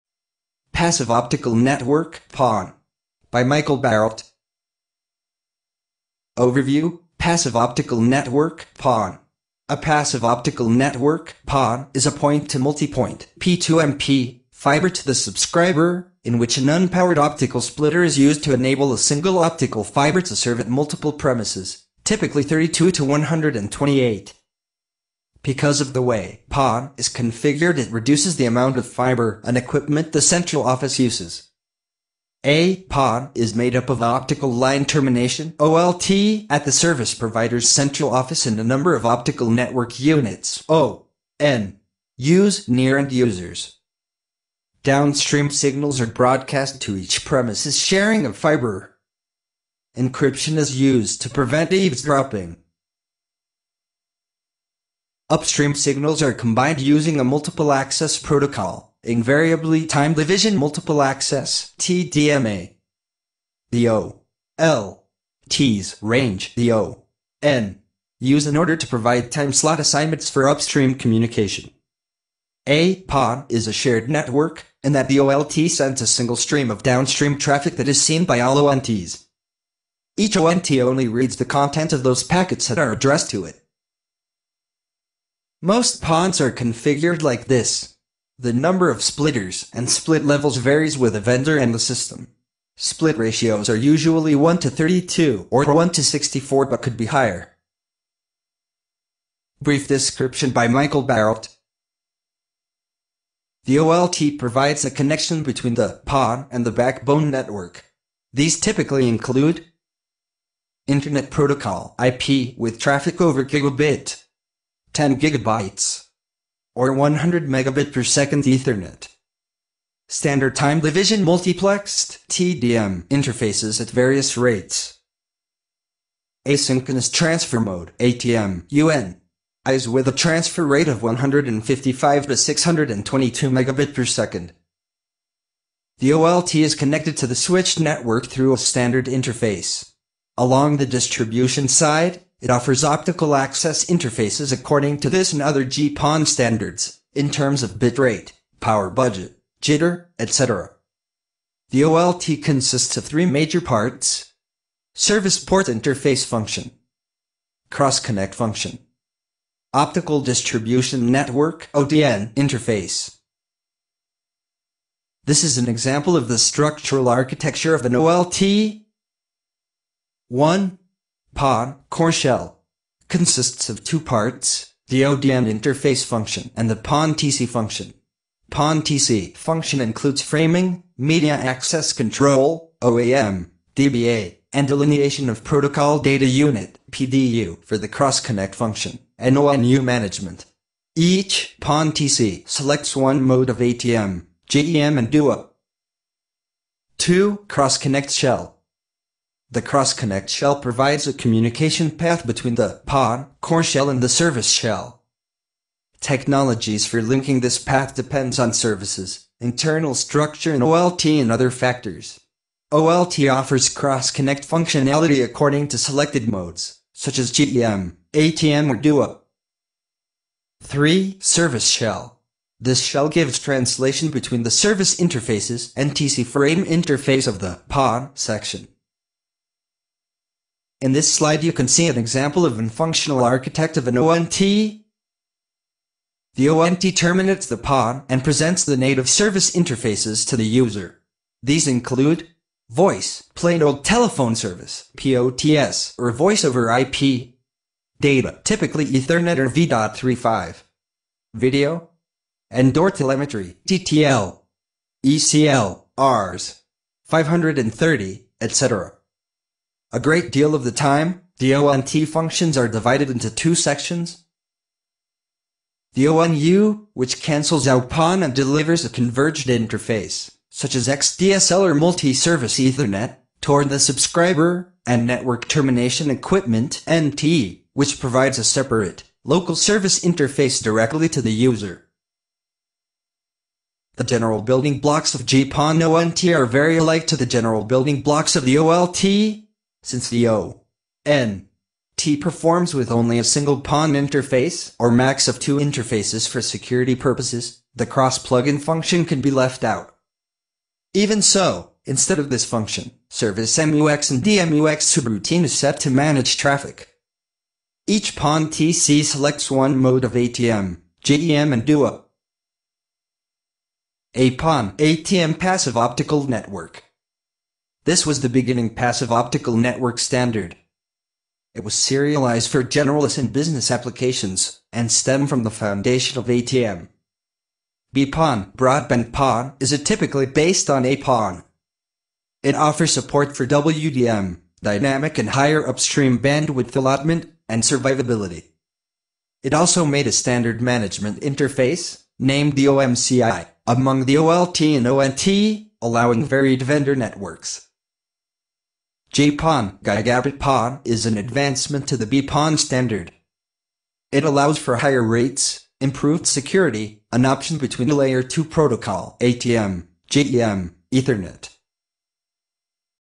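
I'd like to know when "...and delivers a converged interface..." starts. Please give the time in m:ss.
4:28.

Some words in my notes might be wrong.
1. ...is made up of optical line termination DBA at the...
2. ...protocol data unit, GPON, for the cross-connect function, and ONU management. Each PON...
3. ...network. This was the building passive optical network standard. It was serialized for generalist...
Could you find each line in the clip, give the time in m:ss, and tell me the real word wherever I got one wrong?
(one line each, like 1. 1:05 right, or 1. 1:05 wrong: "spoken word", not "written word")
1. 0:33 wrong: "OLT", not "DBA"
2. 3:05 wrong: "PDU", not "GPON"
3. 5:16 wrong: "beginning", not "building".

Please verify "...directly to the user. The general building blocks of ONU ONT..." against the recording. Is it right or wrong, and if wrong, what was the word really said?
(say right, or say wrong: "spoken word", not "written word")
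wrong: "GPON", not "ONU".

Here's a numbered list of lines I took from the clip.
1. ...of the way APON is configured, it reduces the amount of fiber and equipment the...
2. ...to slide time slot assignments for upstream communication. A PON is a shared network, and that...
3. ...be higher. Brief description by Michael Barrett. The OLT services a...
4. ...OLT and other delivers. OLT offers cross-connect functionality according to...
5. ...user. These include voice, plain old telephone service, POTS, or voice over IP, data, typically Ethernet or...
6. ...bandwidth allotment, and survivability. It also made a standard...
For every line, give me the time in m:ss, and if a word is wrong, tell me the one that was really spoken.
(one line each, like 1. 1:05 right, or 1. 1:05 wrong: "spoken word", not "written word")
1. 0:25 wrong: "PON", not "APON"
2. 1:08 wrong: "provide", not "slide"
3. 1:36 wrong: "provides", not "services"
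4. 3:30 wrong: "factors", not "delivers"
5. 4:00 right
6. 5:36 right.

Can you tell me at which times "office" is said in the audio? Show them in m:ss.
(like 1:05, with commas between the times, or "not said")
0:30, 0:38.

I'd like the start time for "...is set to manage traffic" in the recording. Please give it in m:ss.
5:05.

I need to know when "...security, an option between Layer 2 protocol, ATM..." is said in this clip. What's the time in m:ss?
5:56.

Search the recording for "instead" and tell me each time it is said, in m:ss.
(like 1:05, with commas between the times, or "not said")
5:01.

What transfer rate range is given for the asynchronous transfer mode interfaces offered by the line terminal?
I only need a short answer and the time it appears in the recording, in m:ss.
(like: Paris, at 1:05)
155 to 622 Mbps, at 2:11.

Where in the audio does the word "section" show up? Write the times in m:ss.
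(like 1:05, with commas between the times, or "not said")
3:48, 4:23.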